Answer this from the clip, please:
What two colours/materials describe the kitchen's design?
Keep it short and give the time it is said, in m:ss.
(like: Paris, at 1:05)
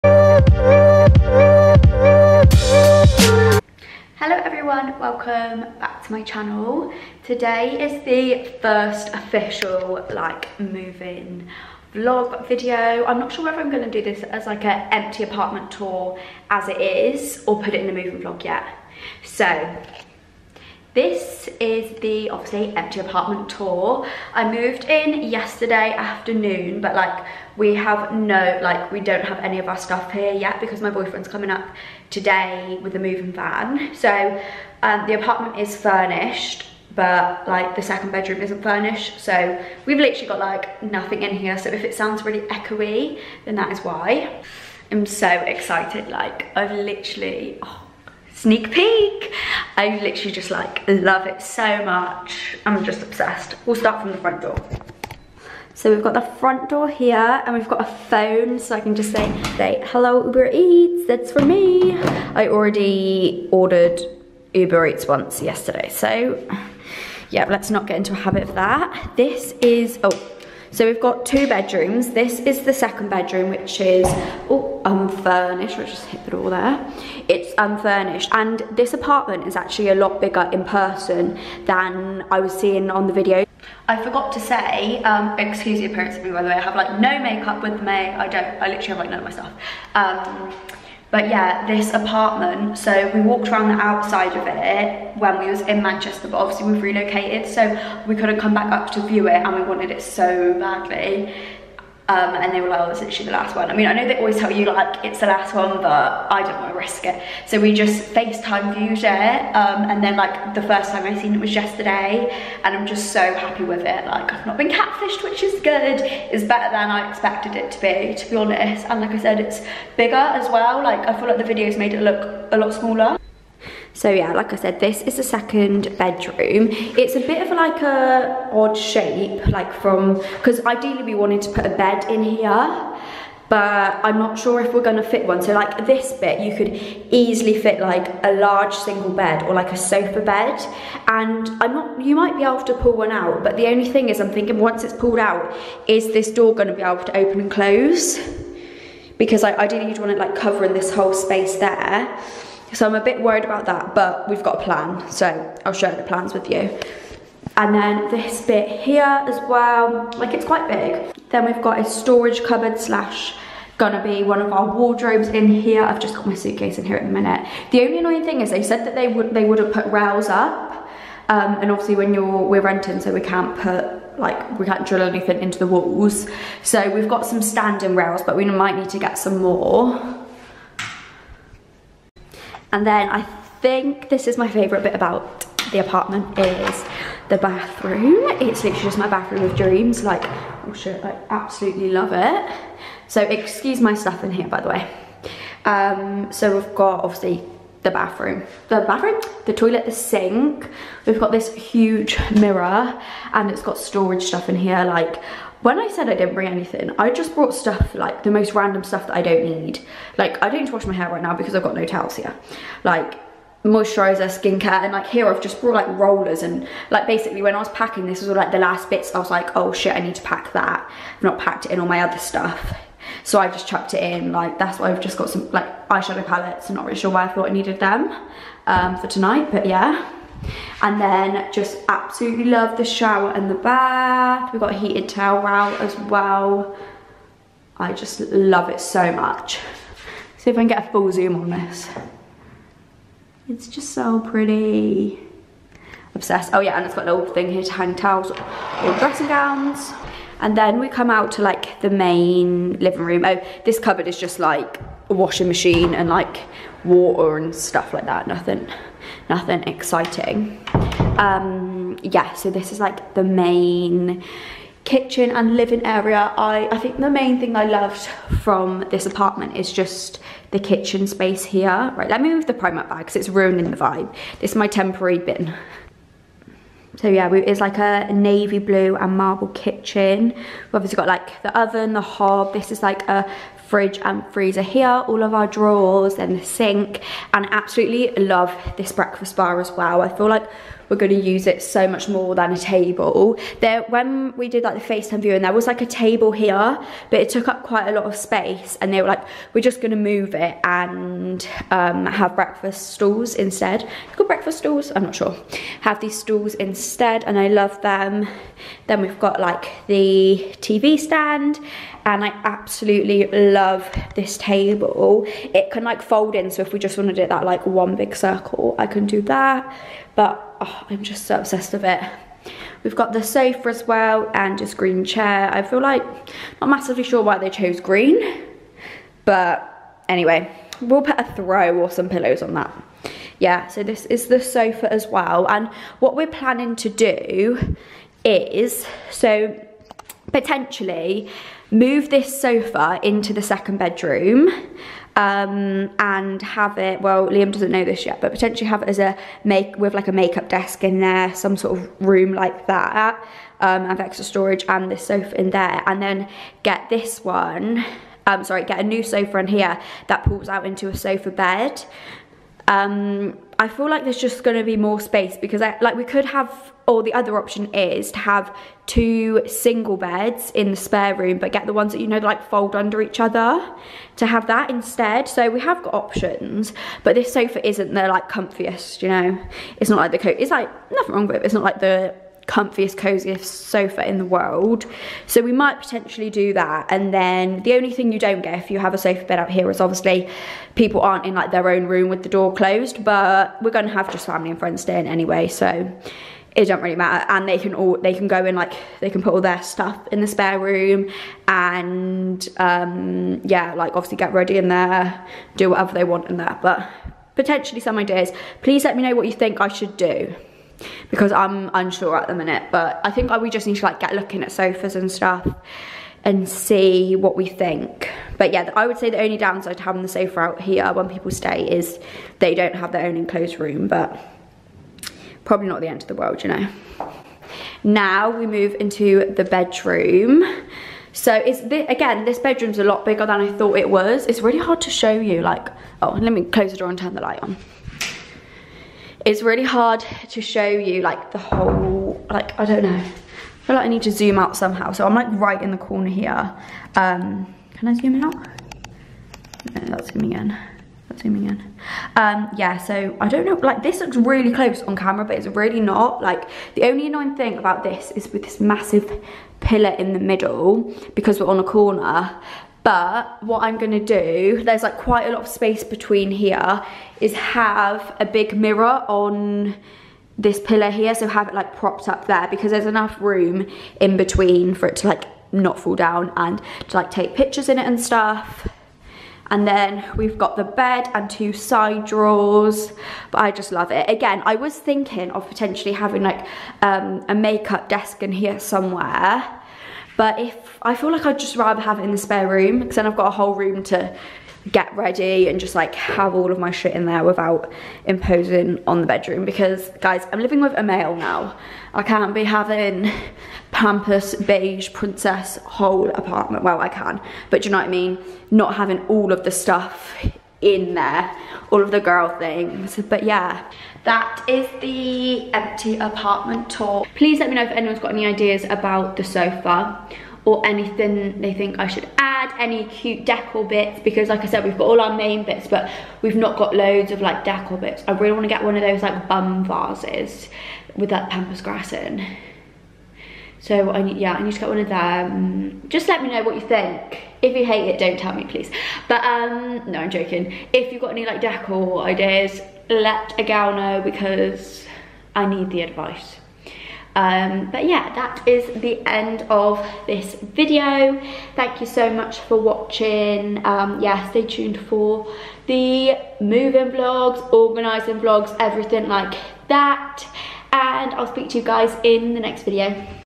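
Navy blue and marble, at 4:38.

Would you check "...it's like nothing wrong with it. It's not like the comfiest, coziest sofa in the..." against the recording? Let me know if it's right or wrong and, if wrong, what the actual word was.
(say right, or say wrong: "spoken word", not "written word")
right.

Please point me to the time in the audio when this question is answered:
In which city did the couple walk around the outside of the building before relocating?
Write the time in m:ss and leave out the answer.
1:35.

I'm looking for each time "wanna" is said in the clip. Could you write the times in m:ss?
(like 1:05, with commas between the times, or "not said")
8:48.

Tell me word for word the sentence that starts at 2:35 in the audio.
So I'll share the plans with you.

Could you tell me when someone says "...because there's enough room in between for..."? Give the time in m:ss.
7:52.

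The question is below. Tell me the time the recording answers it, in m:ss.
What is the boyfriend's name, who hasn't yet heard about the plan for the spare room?
5:47.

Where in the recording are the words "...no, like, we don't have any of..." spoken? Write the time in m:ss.
0:28.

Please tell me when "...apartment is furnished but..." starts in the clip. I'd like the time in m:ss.
0:35.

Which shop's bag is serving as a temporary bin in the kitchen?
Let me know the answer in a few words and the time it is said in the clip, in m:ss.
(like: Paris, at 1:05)
Primark, at 4:32.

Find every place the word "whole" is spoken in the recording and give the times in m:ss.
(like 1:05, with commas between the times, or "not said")
2:30, 7:21, 8:13, 8:25.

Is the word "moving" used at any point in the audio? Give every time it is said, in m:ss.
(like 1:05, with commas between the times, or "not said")
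0:10, 0:17, 0:32, 9:16.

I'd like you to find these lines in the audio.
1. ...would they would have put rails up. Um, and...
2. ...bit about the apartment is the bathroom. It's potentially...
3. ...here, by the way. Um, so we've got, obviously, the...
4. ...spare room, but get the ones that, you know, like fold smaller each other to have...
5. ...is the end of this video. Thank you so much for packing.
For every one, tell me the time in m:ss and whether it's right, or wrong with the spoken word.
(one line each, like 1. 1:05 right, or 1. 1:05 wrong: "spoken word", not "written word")
1. 2:49 right
2. 3:04 wrong: "literally", not "potentially"
3. 3:14 right
4. 6:10 wrong: "under", not "smaller"
5. 9:08 wrong: "watching", not "packing".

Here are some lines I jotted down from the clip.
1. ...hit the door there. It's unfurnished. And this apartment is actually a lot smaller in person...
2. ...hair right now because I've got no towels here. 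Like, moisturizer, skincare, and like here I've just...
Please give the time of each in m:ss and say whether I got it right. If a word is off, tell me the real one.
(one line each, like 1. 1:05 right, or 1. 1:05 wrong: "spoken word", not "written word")
1. 1:16 wrong: "bigger", not "smaller"
2. 3:30 right.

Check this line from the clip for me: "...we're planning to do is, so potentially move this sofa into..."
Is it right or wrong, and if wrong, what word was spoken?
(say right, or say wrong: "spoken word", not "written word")
right.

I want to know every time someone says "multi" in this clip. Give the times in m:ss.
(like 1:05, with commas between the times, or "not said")
not said.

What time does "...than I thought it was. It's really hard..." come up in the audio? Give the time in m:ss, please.
7:13.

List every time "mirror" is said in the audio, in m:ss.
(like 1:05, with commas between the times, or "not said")
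3:22, 7:48.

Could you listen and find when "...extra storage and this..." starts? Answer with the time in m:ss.
5:53.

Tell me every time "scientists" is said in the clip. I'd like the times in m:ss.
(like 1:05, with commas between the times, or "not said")
not said.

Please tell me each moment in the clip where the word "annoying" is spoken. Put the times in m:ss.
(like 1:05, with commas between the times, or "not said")
2:47, 7:37.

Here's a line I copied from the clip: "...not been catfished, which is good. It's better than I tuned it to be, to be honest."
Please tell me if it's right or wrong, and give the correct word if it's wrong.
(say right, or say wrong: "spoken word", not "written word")
wrong: "expected", not "tuned".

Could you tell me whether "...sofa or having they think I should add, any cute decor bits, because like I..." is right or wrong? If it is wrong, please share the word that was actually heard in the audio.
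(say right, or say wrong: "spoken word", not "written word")
wrong: "anything", not "having".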